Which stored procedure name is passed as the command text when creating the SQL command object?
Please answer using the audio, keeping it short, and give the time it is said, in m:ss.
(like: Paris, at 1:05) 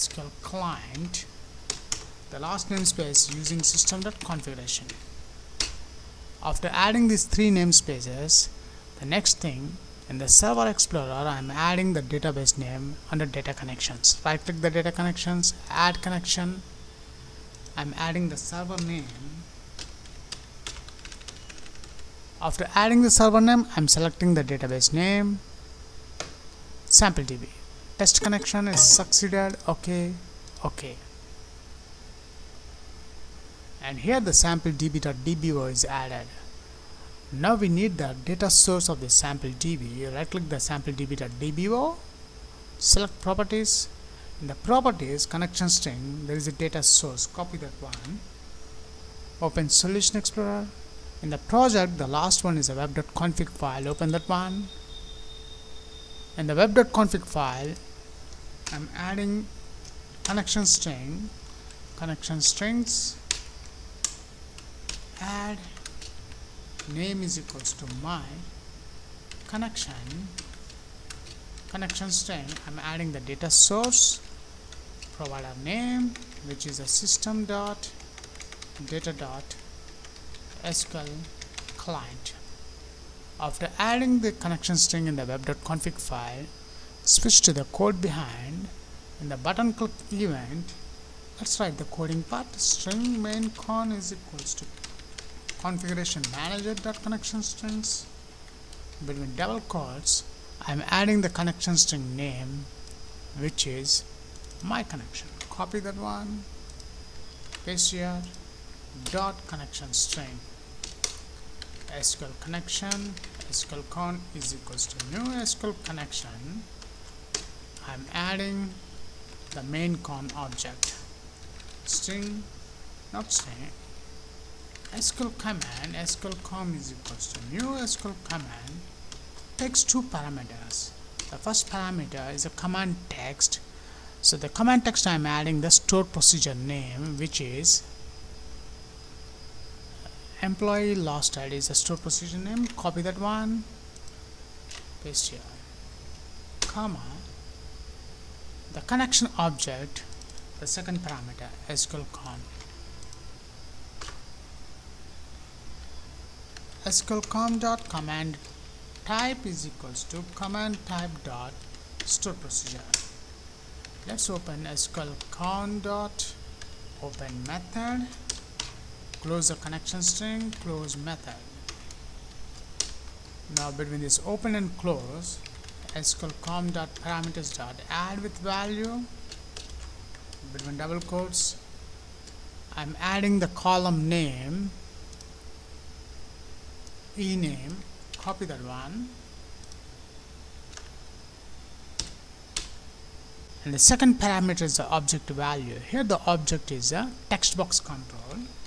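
employee lost ID, at 2:20.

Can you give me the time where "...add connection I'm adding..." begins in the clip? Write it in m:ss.
0:15.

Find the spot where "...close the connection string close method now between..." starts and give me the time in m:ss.
2:49.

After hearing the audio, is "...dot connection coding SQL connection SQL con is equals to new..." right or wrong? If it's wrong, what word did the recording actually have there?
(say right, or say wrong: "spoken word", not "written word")
wrong: "string", not "coding".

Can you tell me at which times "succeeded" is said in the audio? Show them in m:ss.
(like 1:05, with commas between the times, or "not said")
0:28.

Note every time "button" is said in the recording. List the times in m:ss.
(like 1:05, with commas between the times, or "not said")
1:29.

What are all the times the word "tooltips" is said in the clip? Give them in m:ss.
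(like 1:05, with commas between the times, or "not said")
not said.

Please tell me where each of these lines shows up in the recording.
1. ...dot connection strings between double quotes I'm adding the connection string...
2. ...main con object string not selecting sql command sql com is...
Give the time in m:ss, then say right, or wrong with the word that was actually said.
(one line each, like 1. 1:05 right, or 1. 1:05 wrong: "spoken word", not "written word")
1. 1:36 right
2. 1:59 wrong: "string", not "selecting".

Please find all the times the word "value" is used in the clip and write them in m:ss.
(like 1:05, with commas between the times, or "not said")
2:58, 3:15.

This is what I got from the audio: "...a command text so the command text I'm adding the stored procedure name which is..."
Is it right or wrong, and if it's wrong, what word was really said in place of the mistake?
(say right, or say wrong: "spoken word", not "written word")
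right.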